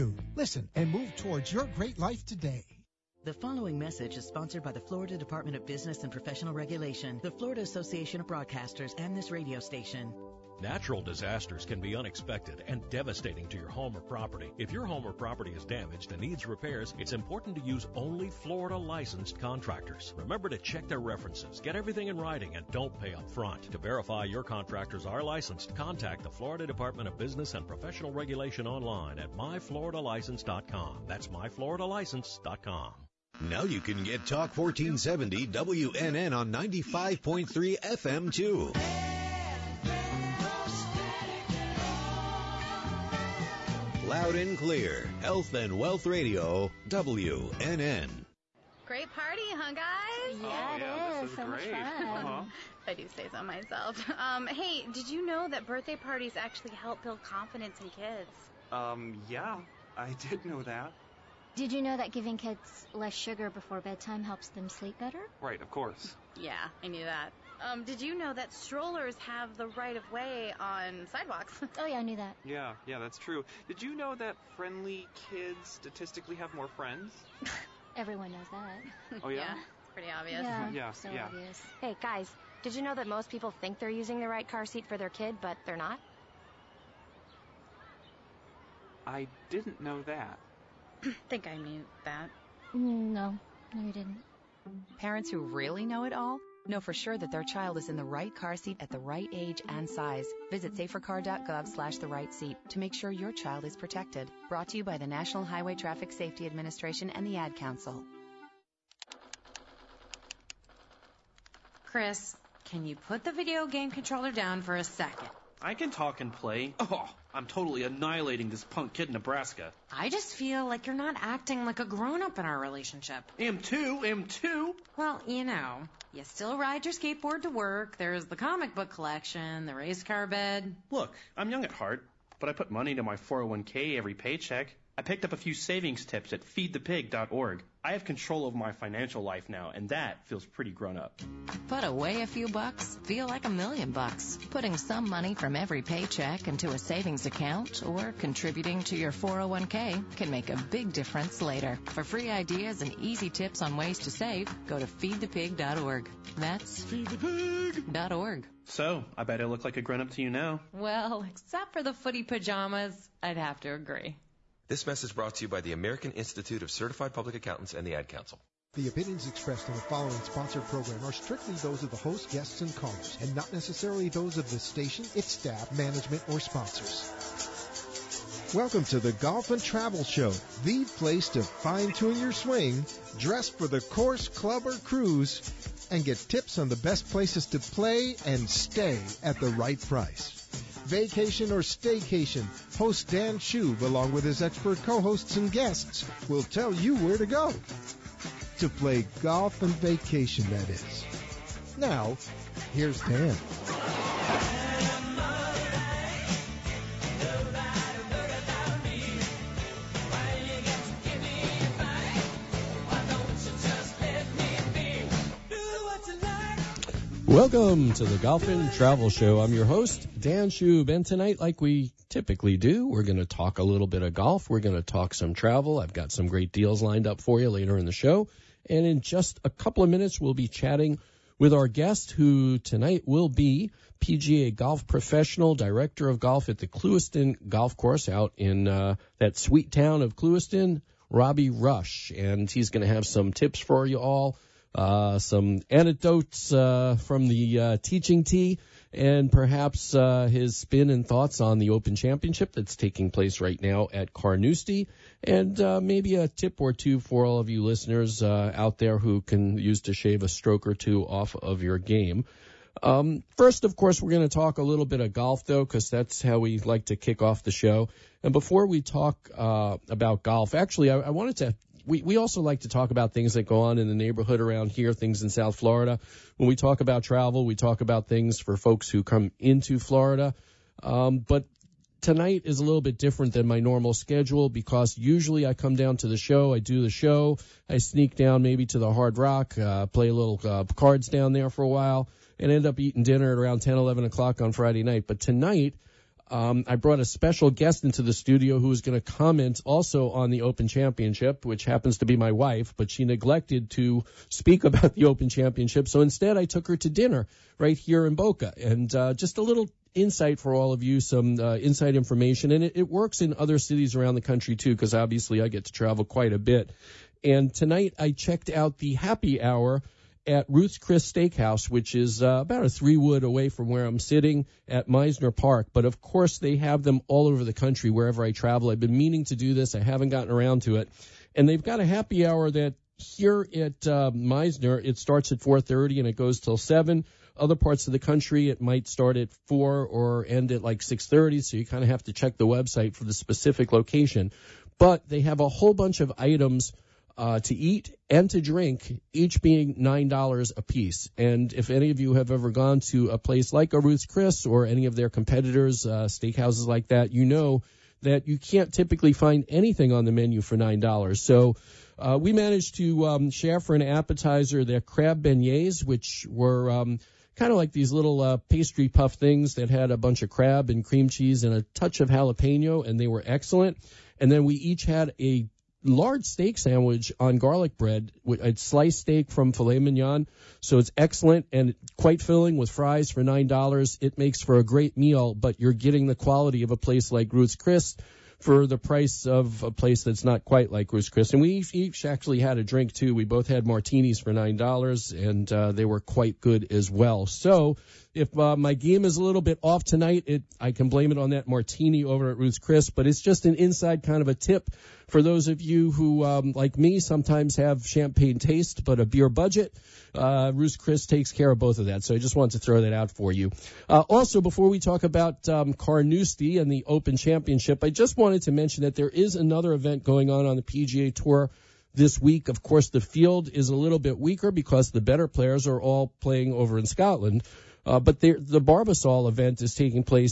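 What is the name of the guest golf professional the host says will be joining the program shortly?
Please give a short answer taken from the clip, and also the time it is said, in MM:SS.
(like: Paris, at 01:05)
Robbie Rush, at 04:01.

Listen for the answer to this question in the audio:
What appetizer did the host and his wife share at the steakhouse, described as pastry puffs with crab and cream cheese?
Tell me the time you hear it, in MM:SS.
06:04.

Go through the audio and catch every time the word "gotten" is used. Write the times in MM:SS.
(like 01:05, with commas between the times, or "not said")
05:30.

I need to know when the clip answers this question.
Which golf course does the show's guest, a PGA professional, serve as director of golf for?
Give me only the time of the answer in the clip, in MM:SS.
03:56.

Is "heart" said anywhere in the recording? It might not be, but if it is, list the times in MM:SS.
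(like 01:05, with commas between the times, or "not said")
02:11.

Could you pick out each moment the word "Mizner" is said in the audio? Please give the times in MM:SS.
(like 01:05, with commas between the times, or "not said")
05:24, 05:34.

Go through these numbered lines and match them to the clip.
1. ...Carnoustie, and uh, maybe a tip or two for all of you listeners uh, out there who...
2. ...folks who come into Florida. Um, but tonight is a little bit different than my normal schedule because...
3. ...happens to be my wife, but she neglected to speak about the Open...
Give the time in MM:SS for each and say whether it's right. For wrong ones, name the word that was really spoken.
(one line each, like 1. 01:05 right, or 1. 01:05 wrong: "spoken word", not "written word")
1. 04:14 right
2. 04:38 right
3. 05:01 right.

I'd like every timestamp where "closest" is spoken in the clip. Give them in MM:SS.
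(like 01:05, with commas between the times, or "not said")
not said.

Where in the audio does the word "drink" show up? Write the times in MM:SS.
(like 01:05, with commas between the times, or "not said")
05:48, 06:32.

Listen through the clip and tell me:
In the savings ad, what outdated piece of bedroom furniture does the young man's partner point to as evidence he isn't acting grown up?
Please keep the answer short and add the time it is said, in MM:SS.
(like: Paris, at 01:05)
race car bed, at 02:09.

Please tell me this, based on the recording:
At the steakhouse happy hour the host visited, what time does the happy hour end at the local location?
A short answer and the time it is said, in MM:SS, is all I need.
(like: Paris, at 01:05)
7, at 05:36.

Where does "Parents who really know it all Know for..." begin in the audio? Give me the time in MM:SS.
01:34.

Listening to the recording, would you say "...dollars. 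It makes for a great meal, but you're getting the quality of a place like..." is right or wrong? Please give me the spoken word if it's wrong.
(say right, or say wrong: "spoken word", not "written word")
right.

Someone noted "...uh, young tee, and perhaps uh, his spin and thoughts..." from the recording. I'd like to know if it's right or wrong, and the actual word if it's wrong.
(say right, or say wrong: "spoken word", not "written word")
wrong: "teaching", not "young".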